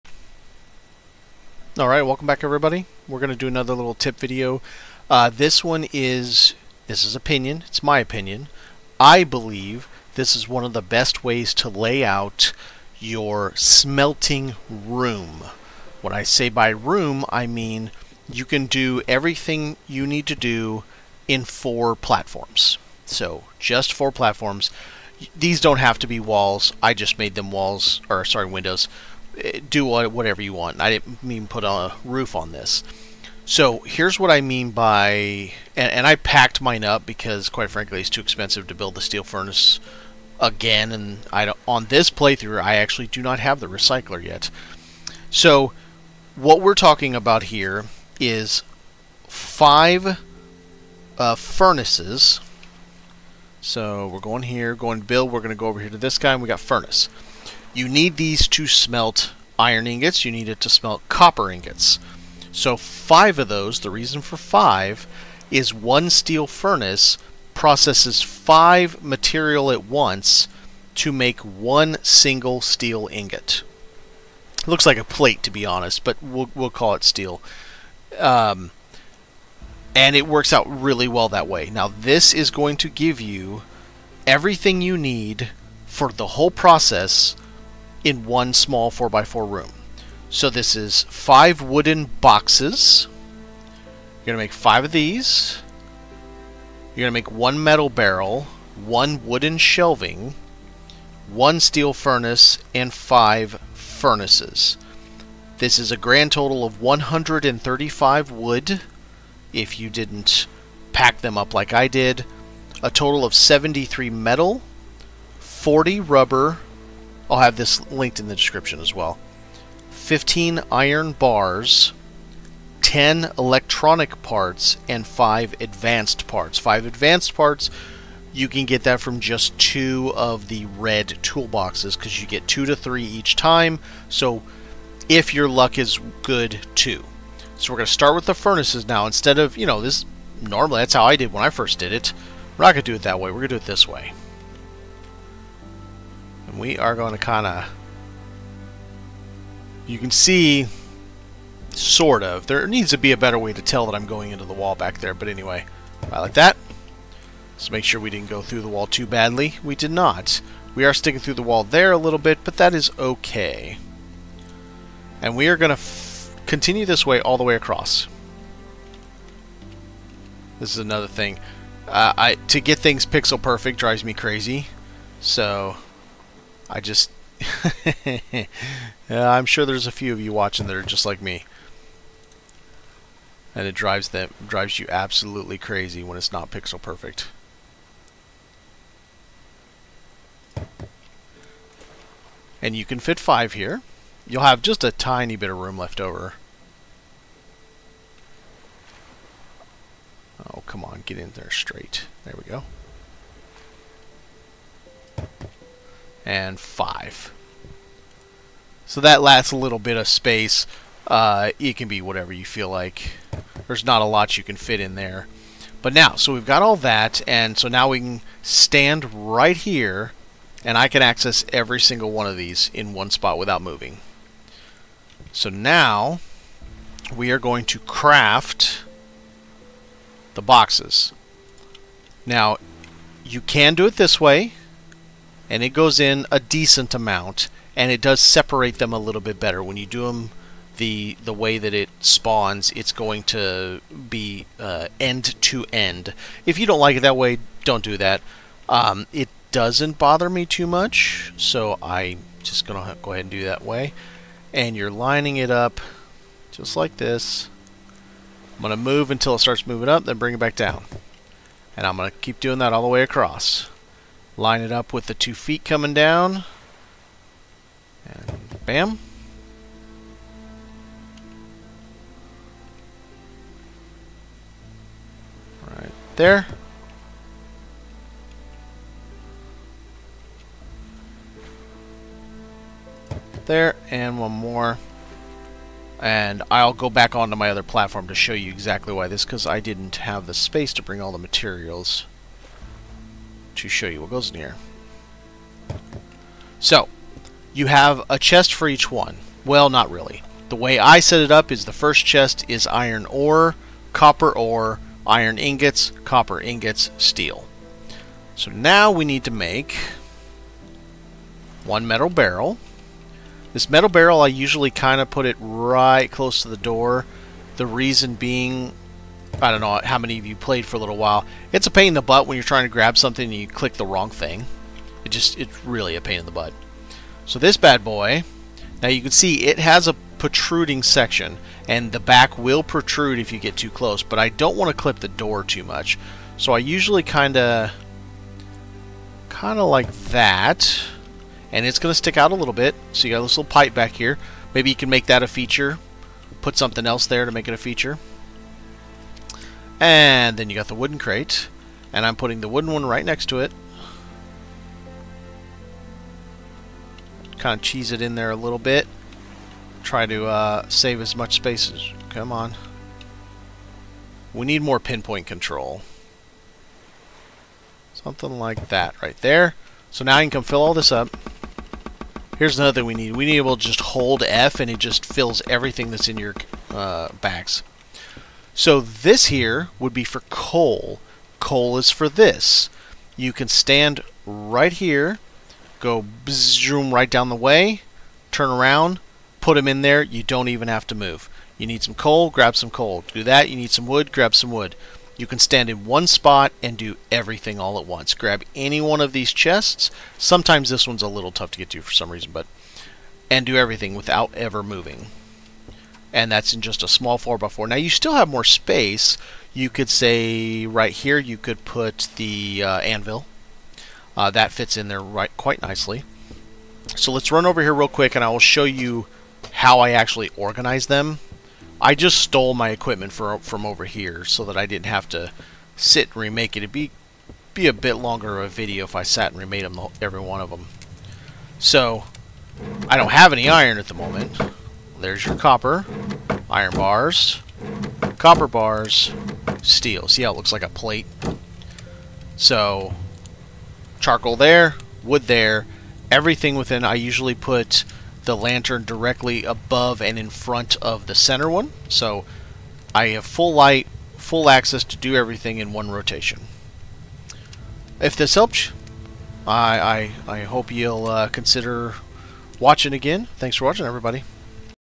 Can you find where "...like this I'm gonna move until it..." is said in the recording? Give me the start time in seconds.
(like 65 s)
256 s.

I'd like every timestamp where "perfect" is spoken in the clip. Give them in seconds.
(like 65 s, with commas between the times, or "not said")
173 s, 186 s.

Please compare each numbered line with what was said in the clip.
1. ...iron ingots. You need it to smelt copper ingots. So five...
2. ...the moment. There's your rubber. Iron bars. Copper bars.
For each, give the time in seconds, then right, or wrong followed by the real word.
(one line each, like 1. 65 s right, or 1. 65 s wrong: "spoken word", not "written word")
1. 59 s right
2. 433 s wrong: "copper", not "rubber".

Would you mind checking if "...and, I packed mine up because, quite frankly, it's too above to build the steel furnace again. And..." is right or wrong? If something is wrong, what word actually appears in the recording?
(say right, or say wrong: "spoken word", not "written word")
wrong: "expensive", not "above".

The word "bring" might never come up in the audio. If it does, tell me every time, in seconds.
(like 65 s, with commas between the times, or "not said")
260 s, 290 s.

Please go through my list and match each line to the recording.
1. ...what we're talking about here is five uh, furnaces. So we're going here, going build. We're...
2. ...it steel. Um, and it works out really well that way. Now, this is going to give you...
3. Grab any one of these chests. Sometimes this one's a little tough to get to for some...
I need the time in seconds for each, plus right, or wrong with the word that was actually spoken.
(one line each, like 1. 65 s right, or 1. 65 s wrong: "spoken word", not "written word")
1. 46 s right
2. 76 s right
3. 398 s right.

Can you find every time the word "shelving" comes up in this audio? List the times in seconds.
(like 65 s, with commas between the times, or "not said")
99 s.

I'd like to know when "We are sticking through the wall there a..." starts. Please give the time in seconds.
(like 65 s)
160 s.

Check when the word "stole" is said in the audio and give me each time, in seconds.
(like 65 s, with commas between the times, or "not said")
422 s.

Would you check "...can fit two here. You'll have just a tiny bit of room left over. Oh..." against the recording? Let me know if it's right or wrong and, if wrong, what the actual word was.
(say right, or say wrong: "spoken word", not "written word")
wrong: "five", not "two".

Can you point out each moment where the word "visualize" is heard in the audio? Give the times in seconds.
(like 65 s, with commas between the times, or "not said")
not said.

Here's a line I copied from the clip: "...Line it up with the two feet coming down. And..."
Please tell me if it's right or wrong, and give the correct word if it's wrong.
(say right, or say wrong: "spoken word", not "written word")
right.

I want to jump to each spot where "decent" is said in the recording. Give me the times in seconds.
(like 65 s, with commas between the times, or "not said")
236 s.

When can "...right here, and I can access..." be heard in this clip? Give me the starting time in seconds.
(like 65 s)
219 s.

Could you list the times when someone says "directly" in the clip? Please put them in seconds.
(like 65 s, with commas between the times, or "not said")
448 s.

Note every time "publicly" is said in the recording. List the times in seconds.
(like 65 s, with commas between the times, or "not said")
not said.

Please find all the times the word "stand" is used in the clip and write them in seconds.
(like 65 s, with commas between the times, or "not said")
218 s, 383 s, 395 s.